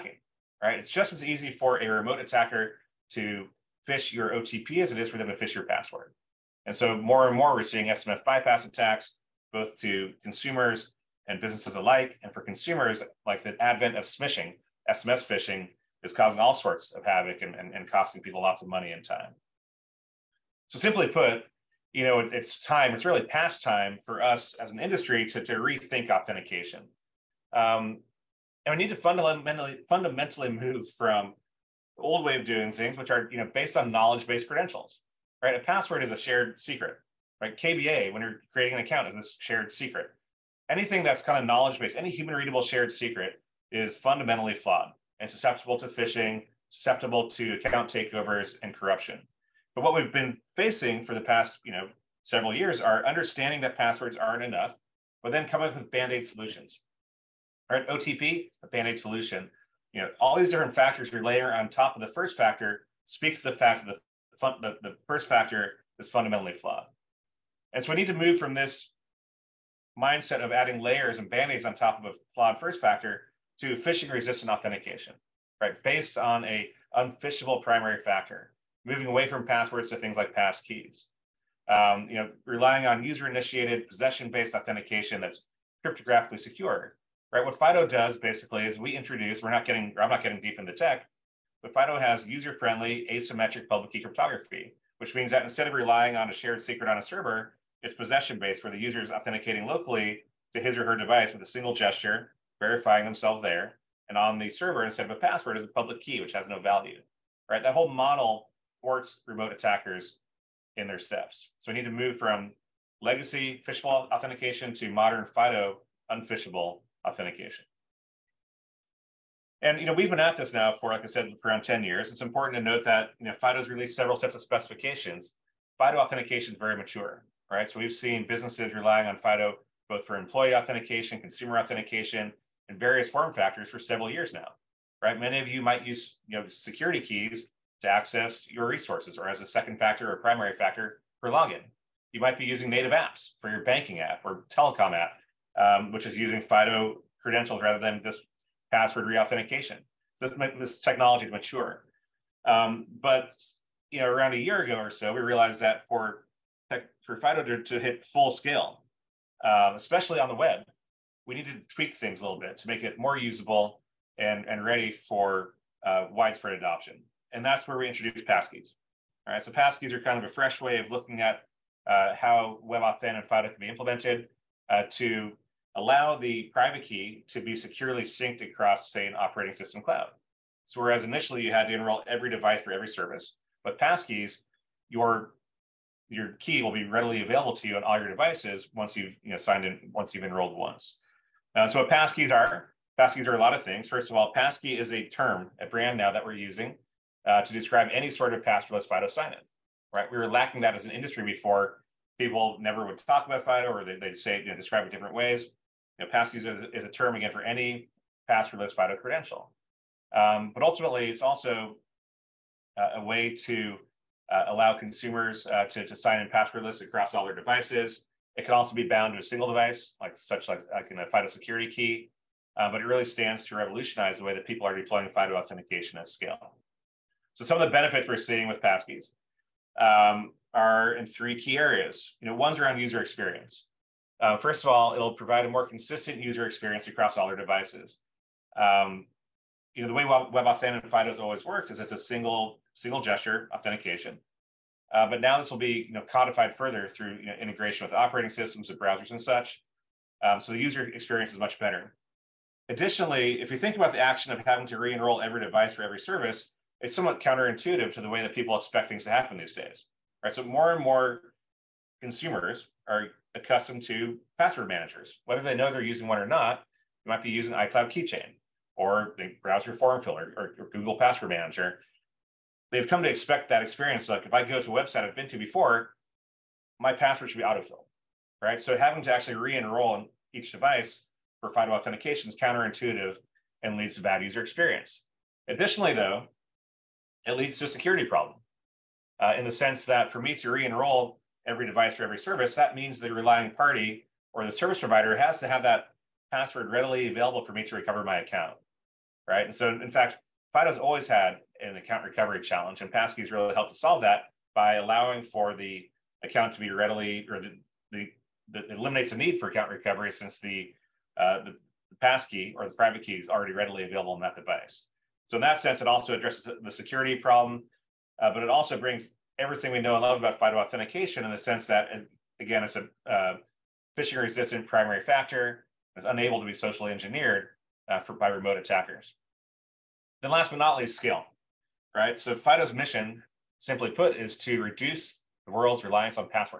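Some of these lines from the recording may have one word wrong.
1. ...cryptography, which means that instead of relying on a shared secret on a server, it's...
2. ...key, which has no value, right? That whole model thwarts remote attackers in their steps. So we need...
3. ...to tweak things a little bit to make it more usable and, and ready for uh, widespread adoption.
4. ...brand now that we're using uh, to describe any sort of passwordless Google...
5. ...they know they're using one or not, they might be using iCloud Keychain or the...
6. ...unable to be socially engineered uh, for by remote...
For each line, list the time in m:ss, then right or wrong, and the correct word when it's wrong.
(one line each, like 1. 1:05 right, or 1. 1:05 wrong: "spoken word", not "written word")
1. 1:34 right
2. 1:46 right
3. 2:41 right
4. 3:15 wrong: "FIDO", not "Google"
5. 4:25 right
6. 5:26 right.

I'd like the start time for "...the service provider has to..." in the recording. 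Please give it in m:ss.
4:54.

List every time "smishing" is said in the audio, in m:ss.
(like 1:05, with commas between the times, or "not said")
0:14.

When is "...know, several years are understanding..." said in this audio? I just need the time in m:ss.
0:51.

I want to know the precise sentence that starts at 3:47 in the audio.
So some of the benefits we're seeing with passkeys um, are in three key areas.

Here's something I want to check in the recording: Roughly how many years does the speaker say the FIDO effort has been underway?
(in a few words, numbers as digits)
10 years.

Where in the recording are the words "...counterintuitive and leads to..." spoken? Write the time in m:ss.
4:42.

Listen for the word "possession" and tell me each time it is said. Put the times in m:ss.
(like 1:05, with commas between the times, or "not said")
1:23, 1:37.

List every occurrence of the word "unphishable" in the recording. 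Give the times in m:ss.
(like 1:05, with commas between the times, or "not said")
1:16, 1:56.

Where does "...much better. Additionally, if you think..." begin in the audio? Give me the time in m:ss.
4:11.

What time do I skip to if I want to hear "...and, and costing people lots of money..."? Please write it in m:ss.
0:17.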